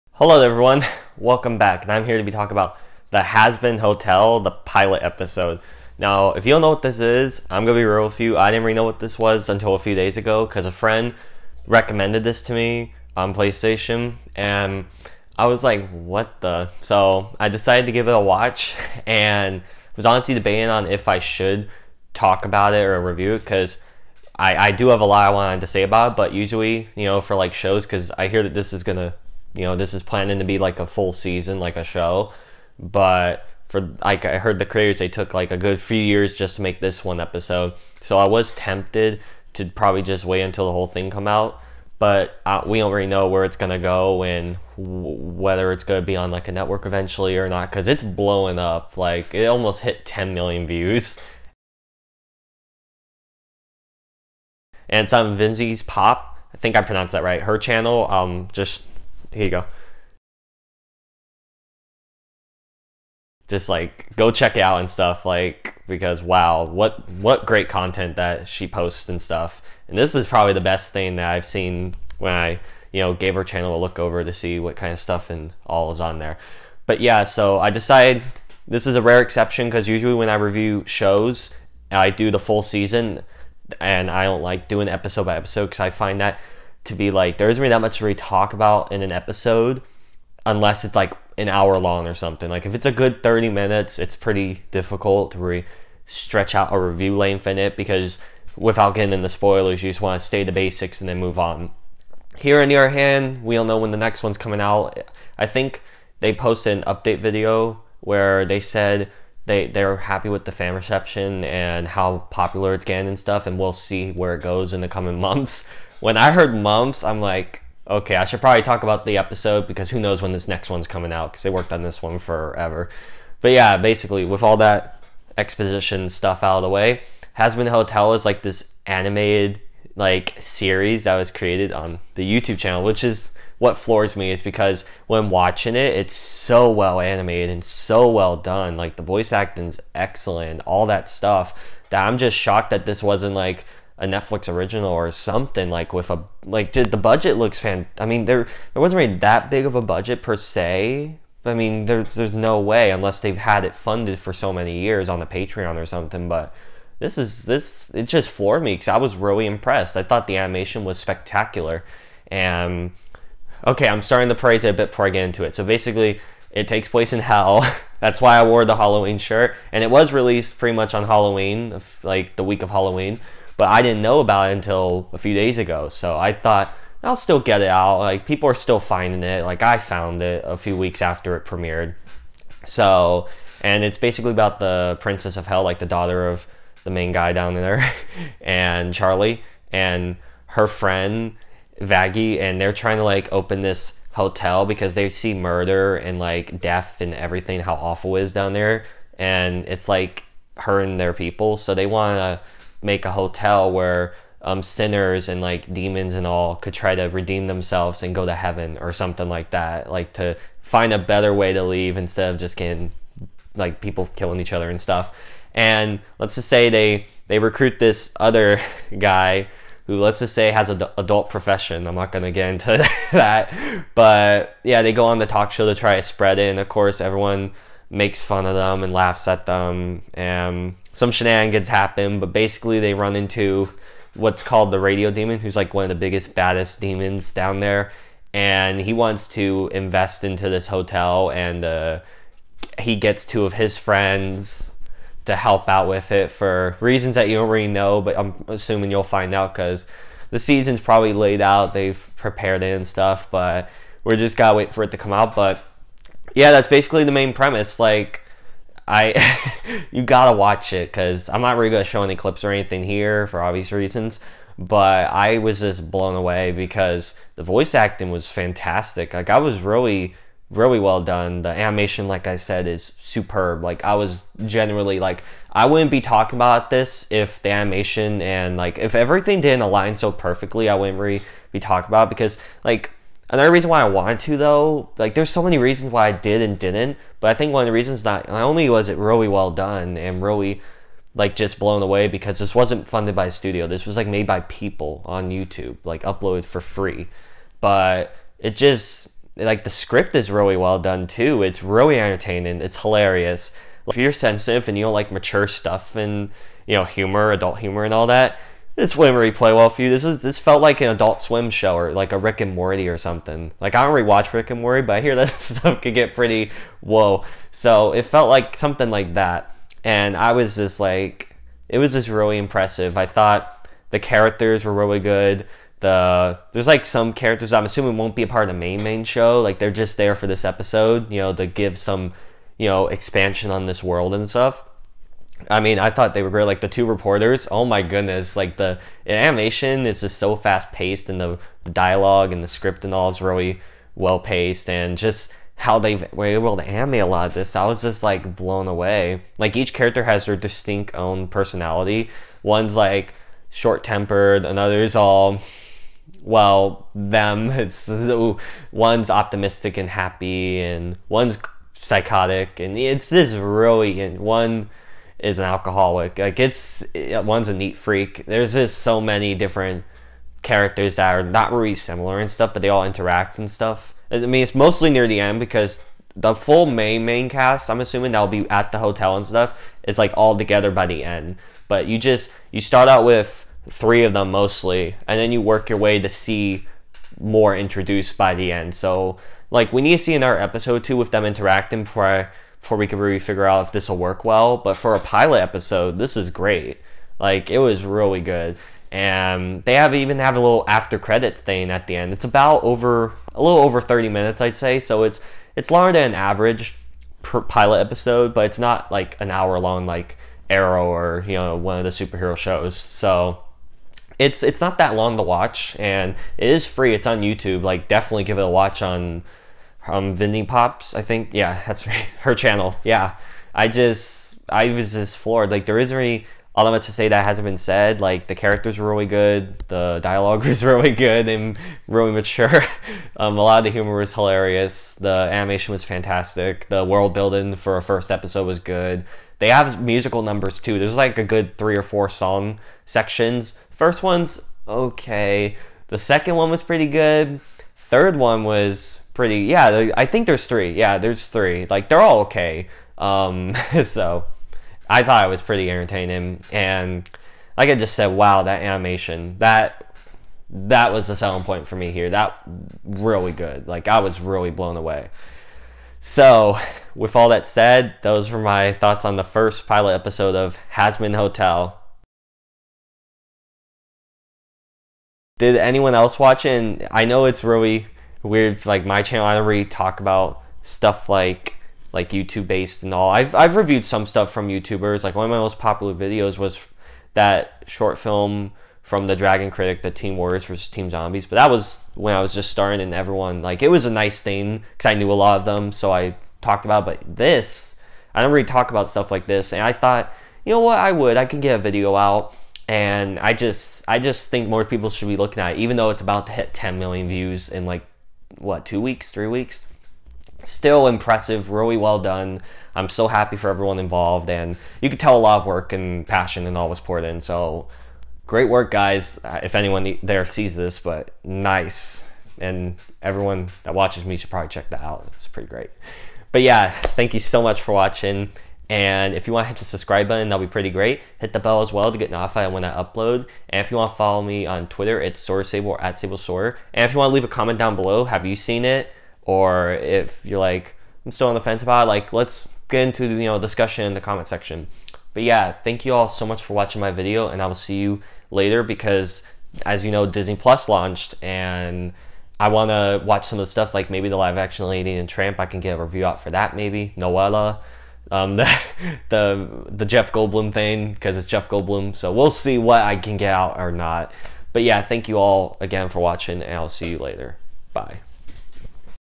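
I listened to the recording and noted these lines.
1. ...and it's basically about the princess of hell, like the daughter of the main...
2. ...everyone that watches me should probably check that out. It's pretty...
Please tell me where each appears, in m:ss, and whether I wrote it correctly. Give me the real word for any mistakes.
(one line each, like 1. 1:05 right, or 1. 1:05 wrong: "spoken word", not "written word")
1. 3:03 right
2. 8:43 right.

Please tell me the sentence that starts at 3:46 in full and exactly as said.
And of course, everyone makes fun of them and laughs at them.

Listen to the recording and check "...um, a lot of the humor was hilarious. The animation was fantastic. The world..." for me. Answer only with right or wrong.
right.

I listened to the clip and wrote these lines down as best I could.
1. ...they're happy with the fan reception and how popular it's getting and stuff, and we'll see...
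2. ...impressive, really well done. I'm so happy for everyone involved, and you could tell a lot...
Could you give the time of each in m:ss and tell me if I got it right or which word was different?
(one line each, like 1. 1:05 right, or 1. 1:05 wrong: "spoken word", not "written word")
1. 1:49 right
2. 8:30 right.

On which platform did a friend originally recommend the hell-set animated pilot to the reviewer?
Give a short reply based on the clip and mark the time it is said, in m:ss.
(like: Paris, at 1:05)
PlayStation, at 0:13.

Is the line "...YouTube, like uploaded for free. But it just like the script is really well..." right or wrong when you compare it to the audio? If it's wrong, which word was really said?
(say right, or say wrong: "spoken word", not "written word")
right.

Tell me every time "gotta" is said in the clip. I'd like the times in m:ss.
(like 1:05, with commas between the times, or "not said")
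4:14, 4:20.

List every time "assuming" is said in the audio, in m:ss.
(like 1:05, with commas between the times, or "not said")
4:08, 5:27, 6:17.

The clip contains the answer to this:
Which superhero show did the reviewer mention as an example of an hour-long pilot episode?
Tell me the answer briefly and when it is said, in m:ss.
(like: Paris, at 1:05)
Arrow, at 6:50.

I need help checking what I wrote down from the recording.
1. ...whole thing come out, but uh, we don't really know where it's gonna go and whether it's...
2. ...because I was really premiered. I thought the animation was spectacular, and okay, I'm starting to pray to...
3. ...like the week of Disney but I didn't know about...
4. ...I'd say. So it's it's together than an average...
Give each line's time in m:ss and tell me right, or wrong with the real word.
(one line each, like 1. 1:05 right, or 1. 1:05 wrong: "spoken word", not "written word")
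1. 0:40 right
2. 2:38 wrong: "impressed", not "premiered"
3. 2:52 wrong: "Halloween", not "Disney"
4. 6:44 wrong: "longer", not "together".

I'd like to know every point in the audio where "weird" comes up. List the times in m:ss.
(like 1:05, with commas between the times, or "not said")
7:58.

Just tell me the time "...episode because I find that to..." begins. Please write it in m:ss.
1:25.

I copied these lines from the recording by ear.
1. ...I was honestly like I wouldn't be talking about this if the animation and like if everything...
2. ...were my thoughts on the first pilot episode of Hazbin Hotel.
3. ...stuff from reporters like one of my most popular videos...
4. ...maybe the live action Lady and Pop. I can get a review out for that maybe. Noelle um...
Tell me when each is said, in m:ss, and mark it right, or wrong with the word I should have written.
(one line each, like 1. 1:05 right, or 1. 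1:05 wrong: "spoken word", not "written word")
1. 4:33 wrong: "generally", not "honestly"
2. 7:48 right
3. 8:04 wrong: "youtubers", not "reporters"
4. 9:13 wrong: "Tramp", not "Pop".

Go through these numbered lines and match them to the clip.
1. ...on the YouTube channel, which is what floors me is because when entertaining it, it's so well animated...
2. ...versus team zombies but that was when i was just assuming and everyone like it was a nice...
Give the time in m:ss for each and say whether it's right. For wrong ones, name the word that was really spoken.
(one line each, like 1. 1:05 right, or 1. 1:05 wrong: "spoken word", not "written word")
1. 2:11 wrong: "watching", not "entertaining"
2. 8:10 wrong: "starting", not "assuming".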